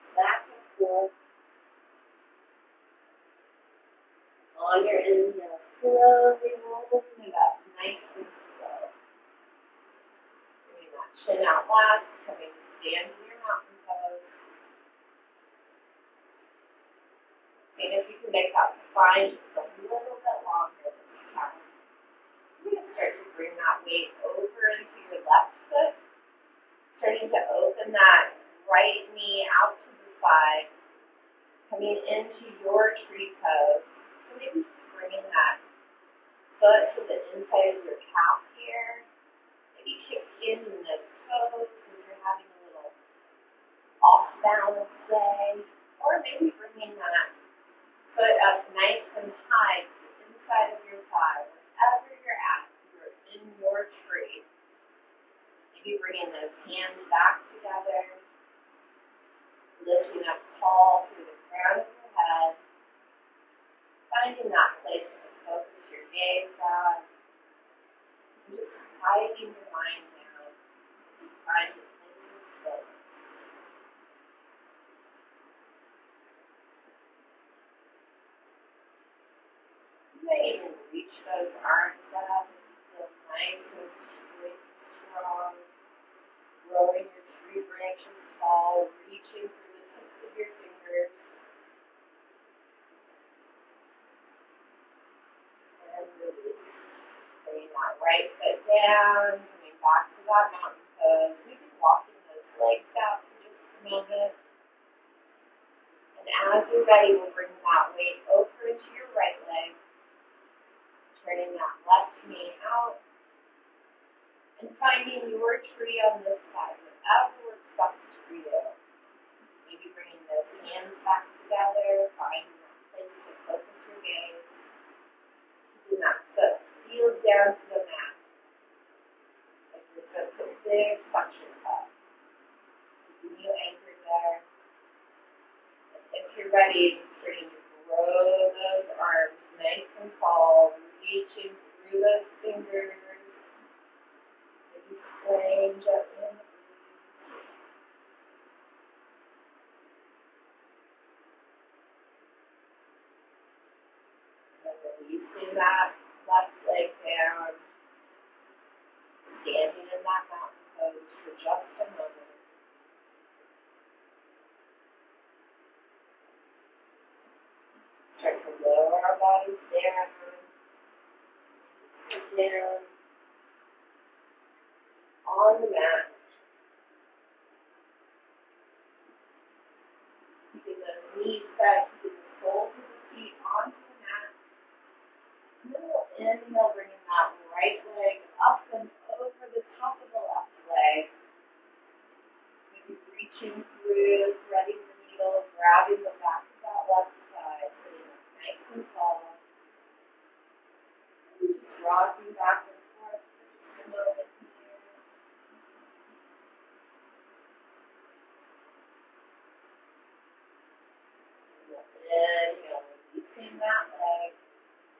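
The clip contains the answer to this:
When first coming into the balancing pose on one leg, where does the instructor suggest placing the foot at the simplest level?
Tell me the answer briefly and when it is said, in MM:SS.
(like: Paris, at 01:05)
Inside of your calf, at 00:37.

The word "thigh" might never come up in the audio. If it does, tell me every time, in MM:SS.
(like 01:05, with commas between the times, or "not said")
00:51, 03:17.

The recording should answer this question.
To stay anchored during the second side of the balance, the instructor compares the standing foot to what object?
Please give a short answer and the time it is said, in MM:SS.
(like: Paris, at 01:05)
A big suction cup, at 02:10.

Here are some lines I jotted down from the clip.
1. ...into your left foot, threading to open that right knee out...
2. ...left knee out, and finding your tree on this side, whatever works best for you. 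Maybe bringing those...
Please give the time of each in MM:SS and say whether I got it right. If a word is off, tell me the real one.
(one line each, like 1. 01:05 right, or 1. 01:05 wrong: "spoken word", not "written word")
1. 00:24 wrong: "starting", not "threading"
2. 01:51 right.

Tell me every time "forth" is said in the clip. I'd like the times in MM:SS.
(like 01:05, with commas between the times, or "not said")
00:00, 03:23.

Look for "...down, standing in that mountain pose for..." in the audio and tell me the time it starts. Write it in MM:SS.
02:37.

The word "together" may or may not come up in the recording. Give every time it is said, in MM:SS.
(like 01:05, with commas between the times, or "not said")
00:57, 02:01.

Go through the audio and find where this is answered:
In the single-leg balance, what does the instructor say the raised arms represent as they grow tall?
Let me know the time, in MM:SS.
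01:27.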